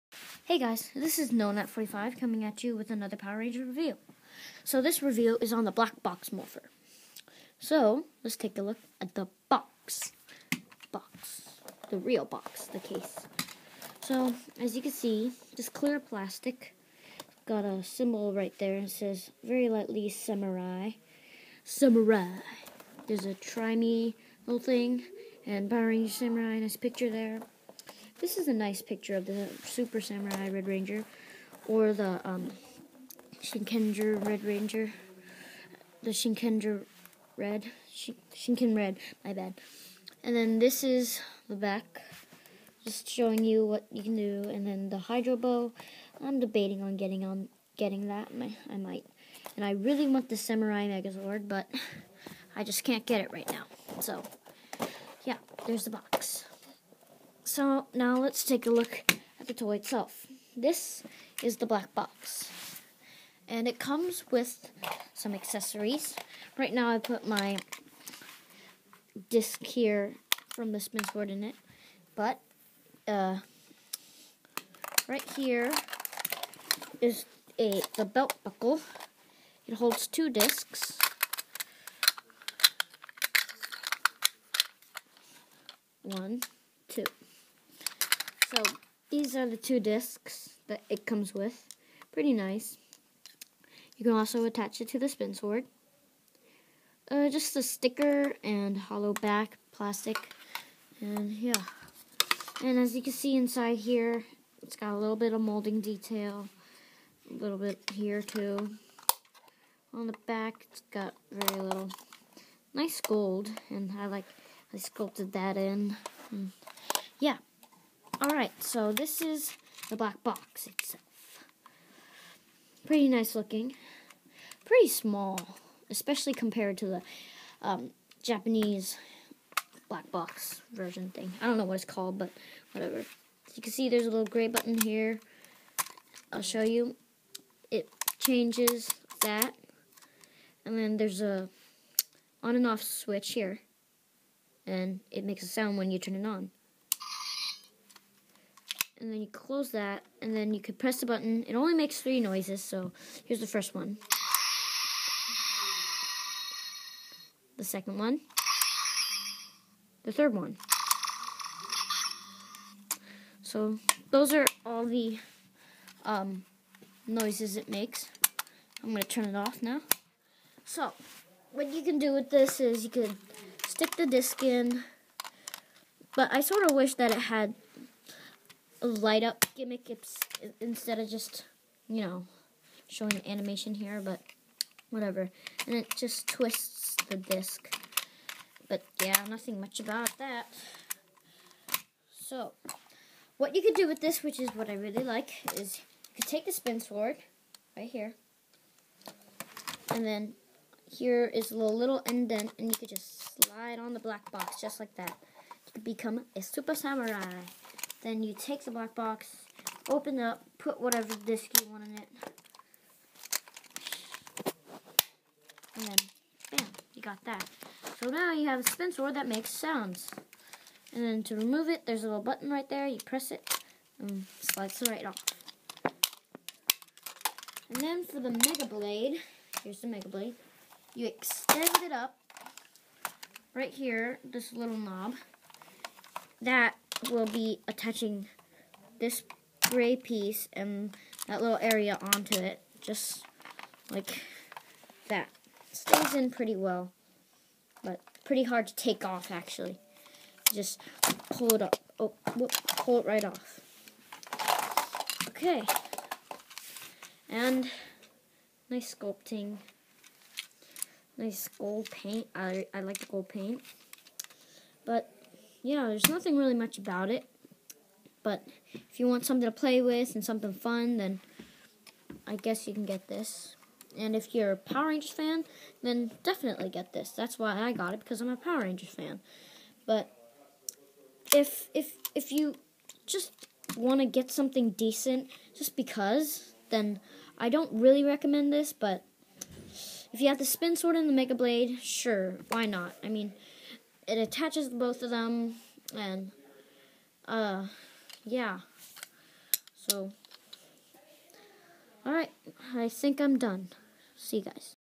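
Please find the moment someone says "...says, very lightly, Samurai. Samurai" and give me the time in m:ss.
0:18.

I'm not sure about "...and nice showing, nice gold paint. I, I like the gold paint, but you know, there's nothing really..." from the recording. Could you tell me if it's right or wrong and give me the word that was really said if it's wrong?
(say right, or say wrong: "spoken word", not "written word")
wrong: "sculpting", not "showing".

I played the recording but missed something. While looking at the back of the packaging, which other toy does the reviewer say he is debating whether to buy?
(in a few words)
Hydro Bow.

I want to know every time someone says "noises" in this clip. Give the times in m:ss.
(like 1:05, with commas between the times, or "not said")
2:32, 2:47.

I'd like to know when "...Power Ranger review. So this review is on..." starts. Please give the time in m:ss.
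0:03.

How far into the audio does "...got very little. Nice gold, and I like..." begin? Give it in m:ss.
1:50.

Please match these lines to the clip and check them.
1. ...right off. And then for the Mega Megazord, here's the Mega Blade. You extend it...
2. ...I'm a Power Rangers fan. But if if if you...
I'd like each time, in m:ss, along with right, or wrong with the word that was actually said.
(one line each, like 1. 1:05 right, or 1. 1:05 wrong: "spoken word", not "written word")
1. 3:44 wrong: "Blade", not "Megazord"
2. 4:38 right.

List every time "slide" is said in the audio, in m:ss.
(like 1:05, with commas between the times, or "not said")
3:23, 3:44.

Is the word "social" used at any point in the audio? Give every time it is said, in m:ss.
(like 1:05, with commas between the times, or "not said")
not said.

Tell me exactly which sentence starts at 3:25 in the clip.
You could become a super samurai.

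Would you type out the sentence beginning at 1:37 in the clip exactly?
Uh, just a sticker and hollow back plastic.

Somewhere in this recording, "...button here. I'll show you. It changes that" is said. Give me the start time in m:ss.
2:14.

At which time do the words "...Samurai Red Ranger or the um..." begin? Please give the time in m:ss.
0:29.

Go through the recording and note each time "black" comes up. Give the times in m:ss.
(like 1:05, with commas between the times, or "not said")
0:05, 1:01, 1:59, 2:09, 3:23, 3:28.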